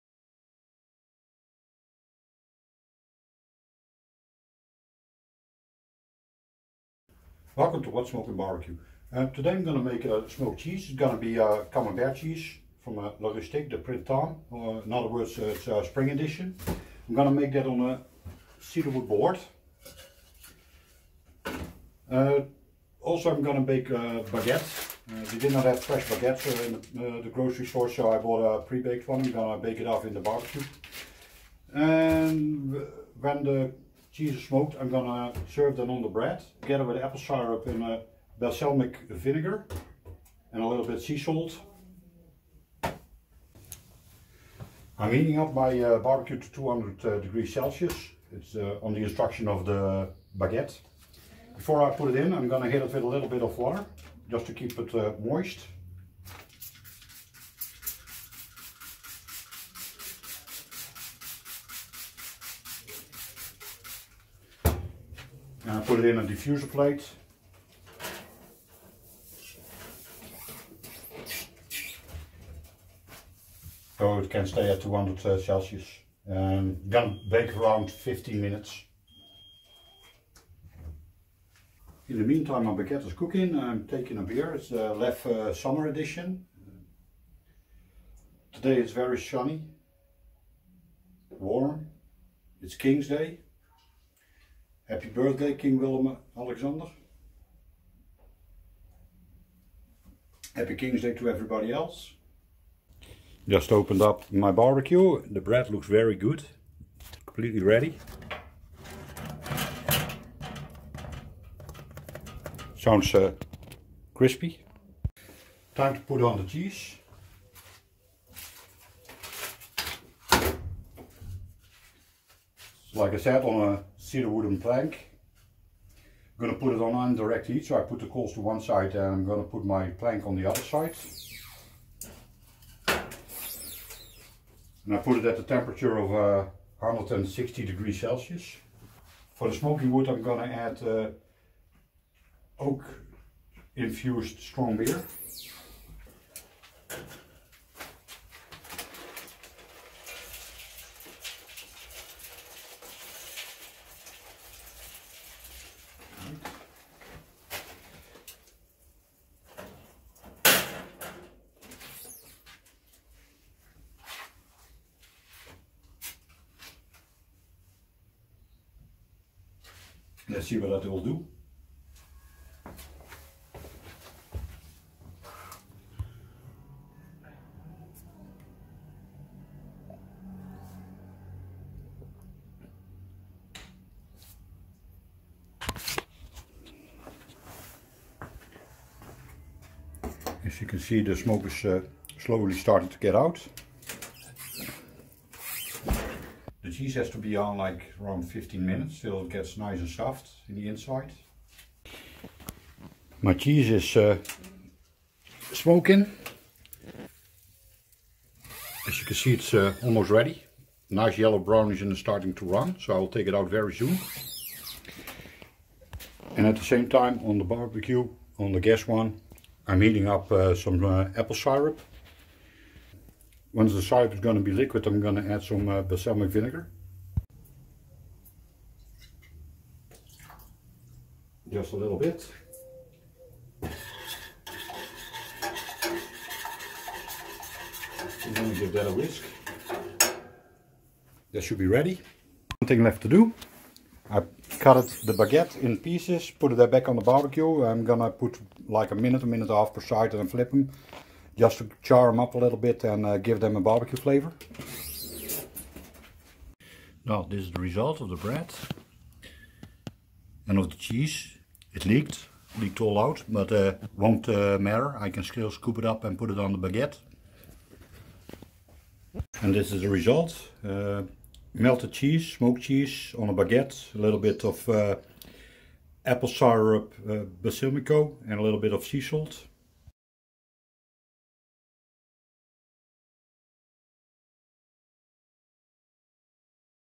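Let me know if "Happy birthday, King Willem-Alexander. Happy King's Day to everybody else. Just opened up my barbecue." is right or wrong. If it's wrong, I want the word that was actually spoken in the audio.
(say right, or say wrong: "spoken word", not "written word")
right.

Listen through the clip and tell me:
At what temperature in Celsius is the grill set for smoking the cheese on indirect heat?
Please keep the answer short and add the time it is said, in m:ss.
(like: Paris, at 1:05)
160 degrees Celsius, at 2:16.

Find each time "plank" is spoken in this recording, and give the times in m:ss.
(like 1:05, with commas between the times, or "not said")
2:04, 2:10.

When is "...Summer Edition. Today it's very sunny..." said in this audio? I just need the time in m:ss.
1:25.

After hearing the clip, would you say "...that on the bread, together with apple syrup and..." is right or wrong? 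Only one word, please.
right.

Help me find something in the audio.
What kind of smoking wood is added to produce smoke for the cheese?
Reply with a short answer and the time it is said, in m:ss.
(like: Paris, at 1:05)
oak infused strong beer, at 2:22.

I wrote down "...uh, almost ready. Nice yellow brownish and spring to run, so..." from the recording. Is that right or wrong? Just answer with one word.
wrong.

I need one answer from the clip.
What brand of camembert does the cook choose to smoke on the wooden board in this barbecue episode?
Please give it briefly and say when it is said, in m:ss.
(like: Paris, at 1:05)
La Rustique, at 0:13.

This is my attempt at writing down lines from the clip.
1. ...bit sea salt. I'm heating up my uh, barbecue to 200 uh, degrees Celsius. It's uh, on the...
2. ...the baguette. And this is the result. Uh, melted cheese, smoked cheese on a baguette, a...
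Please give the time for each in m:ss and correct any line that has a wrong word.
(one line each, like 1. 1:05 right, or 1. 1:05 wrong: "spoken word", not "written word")
1. 0:40 right
2. 4:26 right.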